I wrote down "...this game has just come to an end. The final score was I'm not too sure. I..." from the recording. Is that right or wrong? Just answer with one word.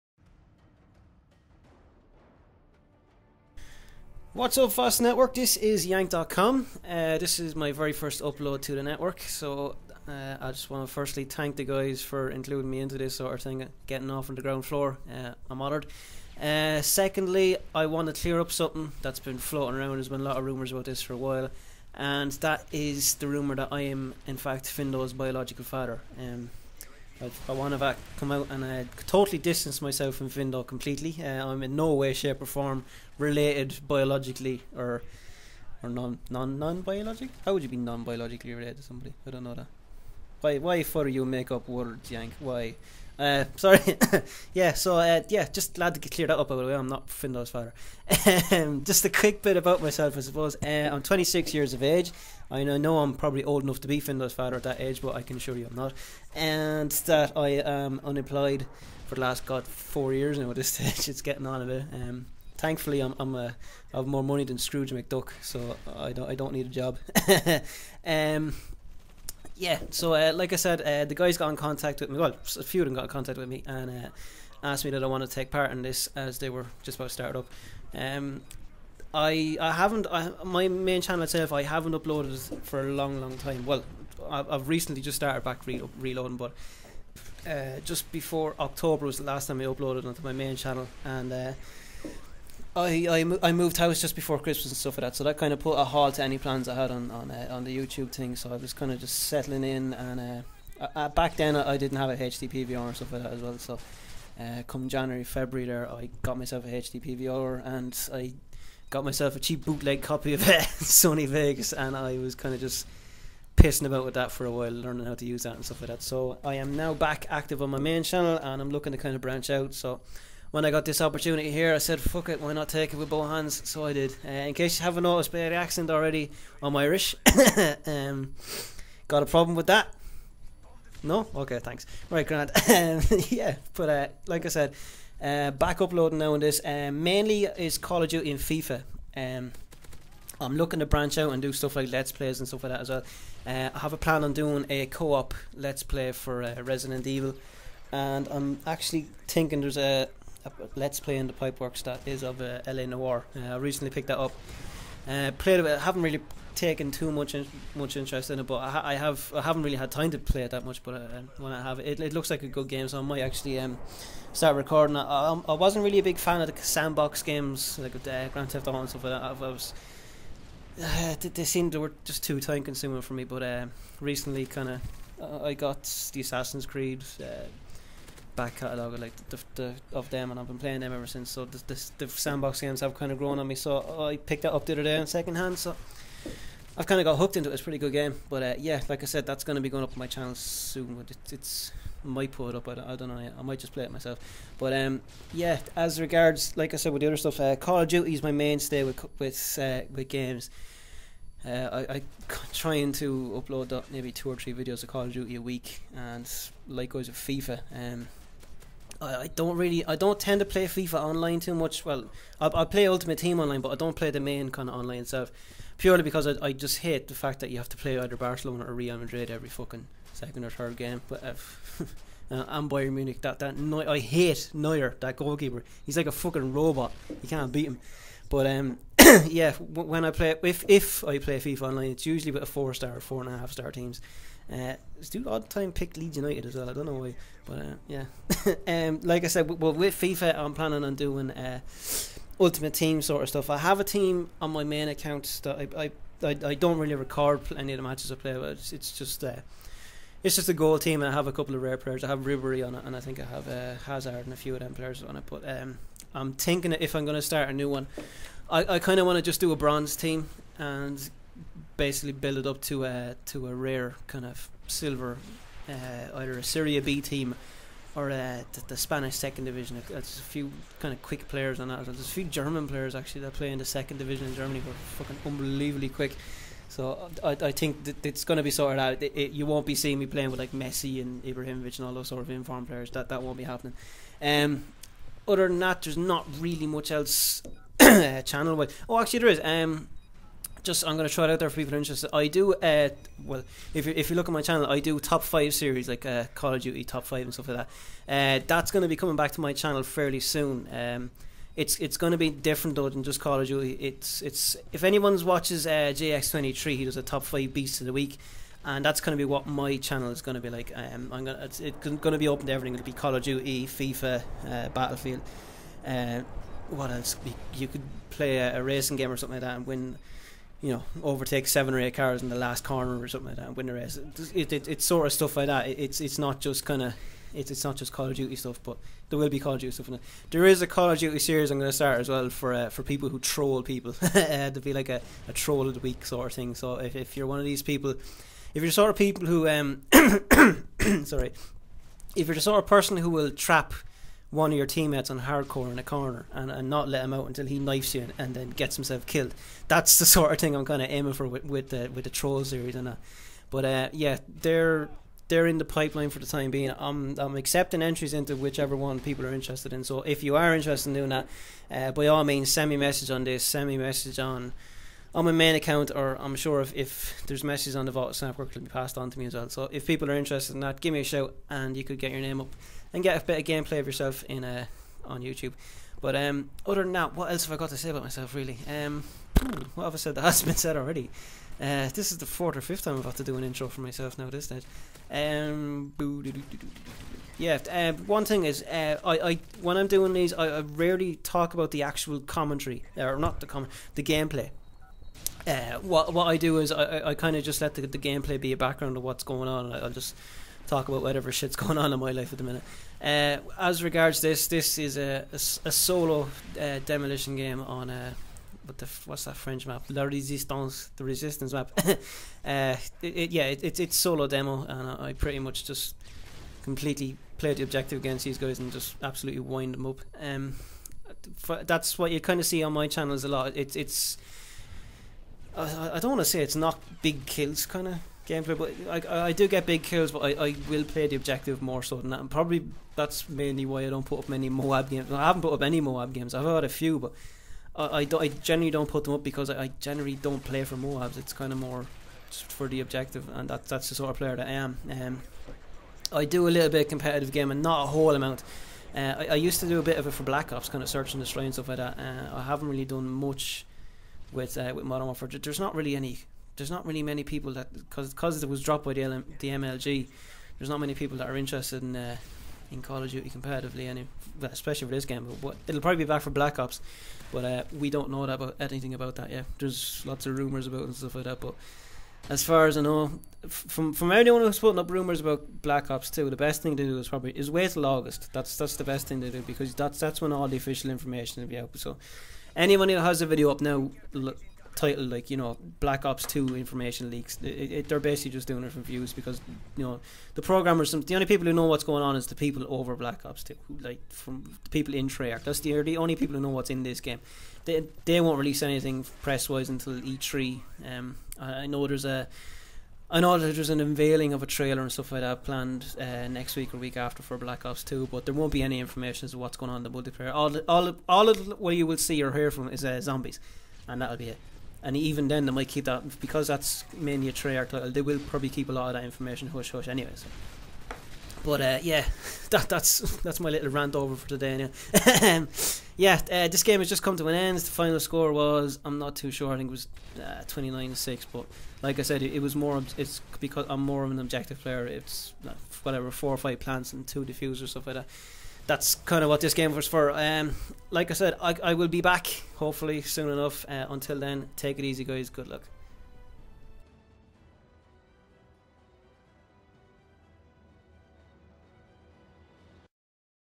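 right.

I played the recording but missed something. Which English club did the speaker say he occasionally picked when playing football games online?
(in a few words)
Leeds United.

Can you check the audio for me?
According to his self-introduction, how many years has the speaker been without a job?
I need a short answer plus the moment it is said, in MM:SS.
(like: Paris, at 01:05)
4, at 00:59.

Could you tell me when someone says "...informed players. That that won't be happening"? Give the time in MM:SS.
04:42.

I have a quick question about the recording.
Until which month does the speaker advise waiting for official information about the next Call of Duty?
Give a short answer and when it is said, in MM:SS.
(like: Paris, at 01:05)
August, at 07:57.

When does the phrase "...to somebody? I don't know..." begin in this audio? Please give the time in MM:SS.
00:38.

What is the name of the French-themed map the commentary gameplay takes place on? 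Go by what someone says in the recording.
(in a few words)
La Resistance.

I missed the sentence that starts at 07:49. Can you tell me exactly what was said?
There's lots of rumors about and stuff like that, but.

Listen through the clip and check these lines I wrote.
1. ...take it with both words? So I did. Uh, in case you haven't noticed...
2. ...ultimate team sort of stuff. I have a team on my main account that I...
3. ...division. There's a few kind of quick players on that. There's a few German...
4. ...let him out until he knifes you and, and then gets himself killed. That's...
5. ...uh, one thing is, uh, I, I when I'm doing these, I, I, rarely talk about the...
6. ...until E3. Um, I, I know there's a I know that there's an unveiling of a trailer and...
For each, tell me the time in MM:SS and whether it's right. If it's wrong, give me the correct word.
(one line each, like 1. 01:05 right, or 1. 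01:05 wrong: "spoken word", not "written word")
1. 02:02 wrong: "hands", not "words"
2. 04:02 right
3. 04:29 right
4. 05:46 right
5. 06:27 right
6. 08:19 right.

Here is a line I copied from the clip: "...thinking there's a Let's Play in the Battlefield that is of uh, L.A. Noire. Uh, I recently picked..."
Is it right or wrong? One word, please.
wrong.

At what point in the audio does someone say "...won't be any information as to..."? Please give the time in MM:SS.
08:28.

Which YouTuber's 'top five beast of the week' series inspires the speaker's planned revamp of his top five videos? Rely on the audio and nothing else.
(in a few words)
JX23.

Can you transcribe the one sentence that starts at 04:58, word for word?
Uh, that's going to be coming back to my channel fairly soon.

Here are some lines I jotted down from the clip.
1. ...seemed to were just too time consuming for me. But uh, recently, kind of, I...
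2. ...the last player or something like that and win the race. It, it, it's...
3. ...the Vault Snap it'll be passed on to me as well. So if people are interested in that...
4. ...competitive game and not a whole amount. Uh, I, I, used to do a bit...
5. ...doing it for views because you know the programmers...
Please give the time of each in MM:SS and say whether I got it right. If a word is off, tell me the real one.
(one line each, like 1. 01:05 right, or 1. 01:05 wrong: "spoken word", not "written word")
1. 02:51 right
2. 05:22 wrong: "corner", not "player"
3. 06:07 right
4. 07:26 right
5. 08:08 right.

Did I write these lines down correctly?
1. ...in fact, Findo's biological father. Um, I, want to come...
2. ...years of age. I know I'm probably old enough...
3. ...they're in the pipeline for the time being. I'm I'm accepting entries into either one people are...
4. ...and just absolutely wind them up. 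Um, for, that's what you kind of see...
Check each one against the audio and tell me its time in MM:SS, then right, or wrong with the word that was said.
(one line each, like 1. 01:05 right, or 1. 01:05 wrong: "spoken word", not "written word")
1. 00:24 right
2. 00:51 right
3. 05:55 wrong: "whichever", not "either"
4. 06:58 right.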